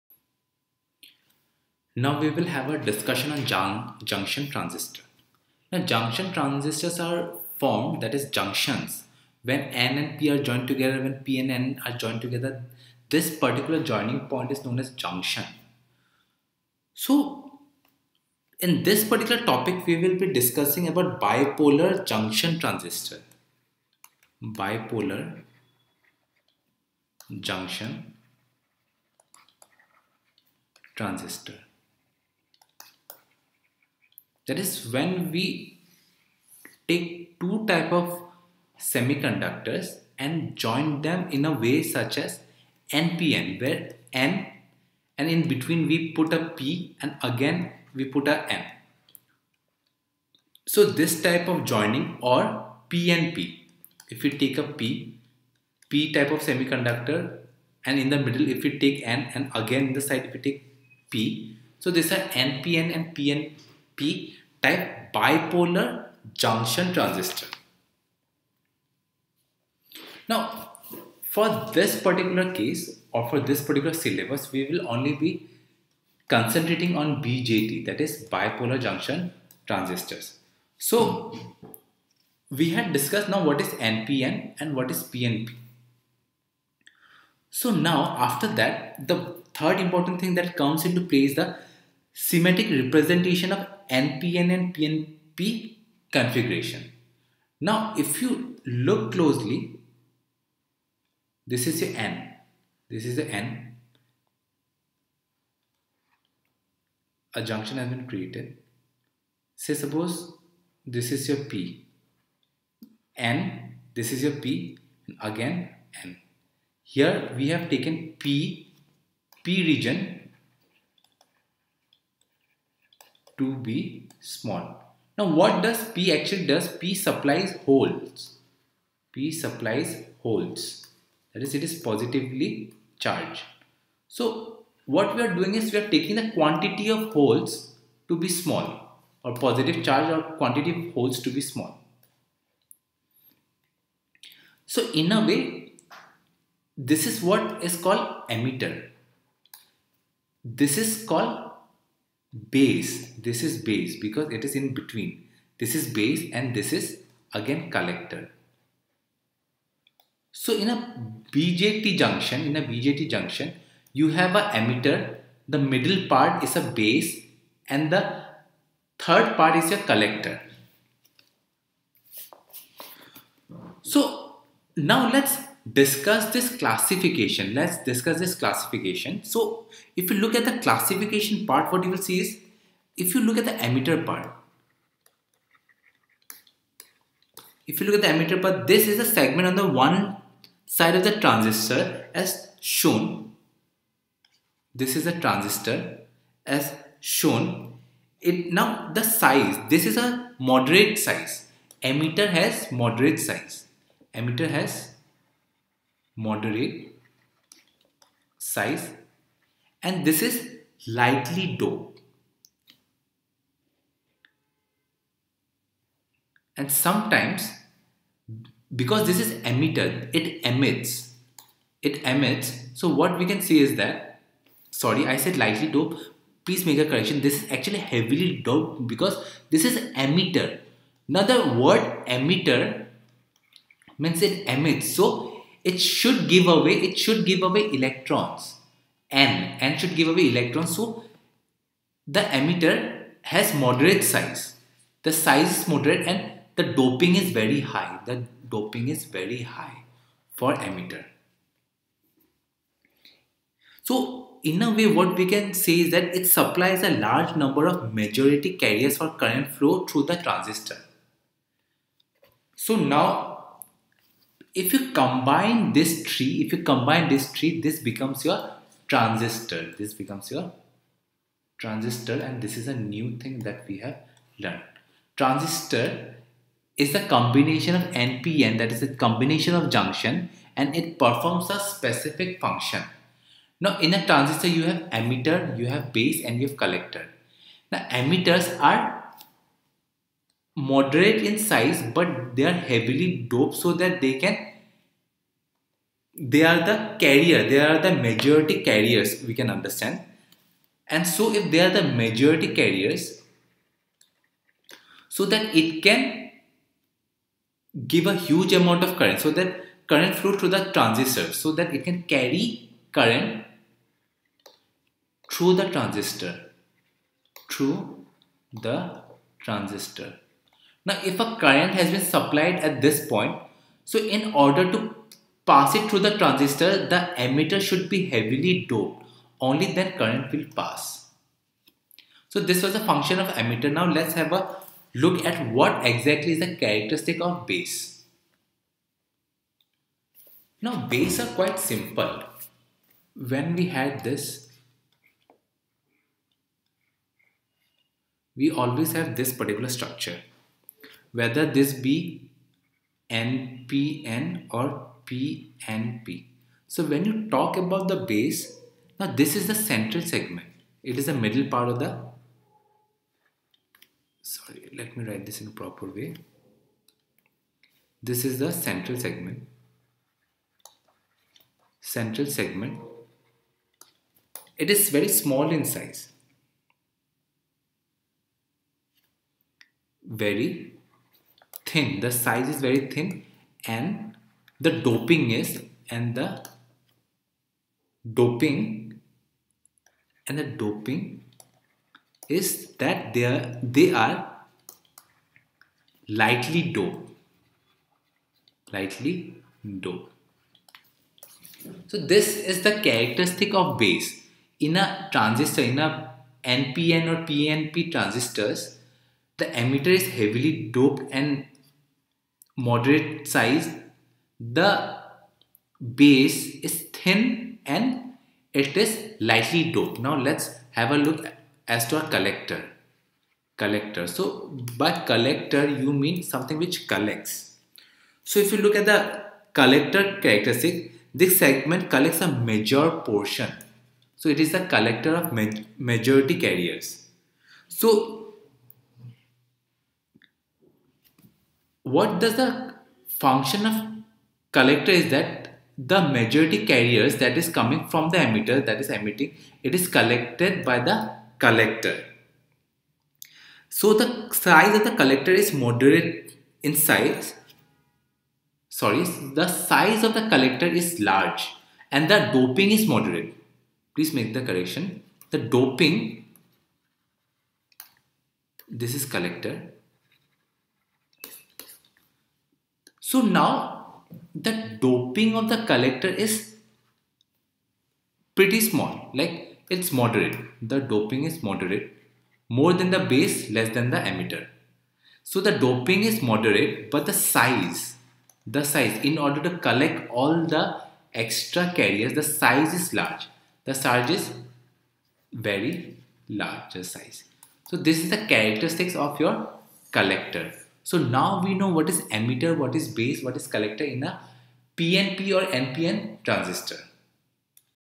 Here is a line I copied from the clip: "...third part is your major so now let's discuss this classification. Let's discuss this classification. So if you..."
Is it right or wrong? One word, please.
wrong.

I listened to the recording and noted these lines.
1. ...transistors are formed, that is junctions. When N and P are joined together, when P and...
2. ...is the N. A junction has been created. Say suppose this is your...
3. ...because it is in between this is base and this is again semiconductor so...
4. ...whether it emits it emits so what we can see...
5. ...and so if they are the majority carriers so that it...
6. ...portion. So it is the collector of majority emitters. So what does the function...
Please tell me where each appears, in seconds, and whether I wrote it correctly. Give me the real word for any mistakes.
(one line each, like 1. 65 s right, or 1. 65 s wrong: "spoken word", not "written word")
1. 6 s right
2. 103 s right
3. 153 s wrong: "collector", not "semiconductor"
4. 219 s wrong: "emitter", not "whether"
5. 300 s right
6. 433 s wrong: "carriers", not "emitters".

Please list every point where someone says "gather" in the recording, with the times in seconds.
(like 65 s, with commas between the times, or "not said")
not said.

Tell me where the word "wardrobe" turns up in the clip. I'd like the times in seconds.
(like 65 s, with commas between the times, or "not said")
not said.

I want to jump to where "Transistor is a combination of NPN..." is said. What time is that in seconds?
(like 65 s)
275 s.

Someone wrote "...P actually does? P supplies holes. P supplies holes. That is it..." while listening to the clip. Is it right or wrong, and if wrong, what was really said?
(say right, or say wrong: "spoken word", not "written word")
right.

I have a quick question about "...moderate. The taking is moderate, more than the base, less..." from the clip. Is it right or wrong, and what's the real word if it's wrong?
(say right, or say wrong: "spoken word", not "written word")
wrong: "doping", not "taking".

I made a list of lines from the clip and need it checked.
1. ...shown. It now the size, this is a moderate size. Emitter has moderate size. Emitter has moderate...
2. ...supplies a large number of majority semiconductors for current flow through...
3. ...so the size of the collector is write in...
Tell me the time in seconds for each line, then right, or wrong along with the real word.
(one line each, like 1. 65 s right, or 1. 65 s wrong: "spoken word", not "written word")
1. 196 s right
2. 256 s wrong: "carriers", not "semiconductors"
3. 453 s wrong: "moderate", not "write".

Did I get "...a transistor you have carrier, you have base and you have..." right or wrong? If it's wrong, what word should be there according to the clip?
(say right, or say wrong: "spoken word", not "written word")
wrong: "emitter", not "carrier".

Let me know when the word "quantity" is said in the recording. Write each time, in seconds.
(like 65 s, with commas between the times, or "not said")
136 s, 140 s.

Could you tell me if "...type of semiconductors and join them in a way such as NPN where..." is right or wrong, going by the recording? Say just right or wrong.
right.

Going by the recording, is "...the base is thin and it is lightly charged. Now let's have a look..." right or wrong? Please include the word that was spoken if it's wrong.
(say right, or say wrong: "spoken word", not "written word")
wrong: "doped", not "charged".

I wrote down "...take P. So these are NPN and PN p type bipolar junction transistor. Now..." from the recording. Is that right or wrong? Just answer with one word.
right.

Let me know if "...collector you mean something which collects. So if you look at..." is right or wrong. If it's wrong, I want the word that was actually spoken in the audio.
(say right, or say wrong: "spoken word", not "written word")
right.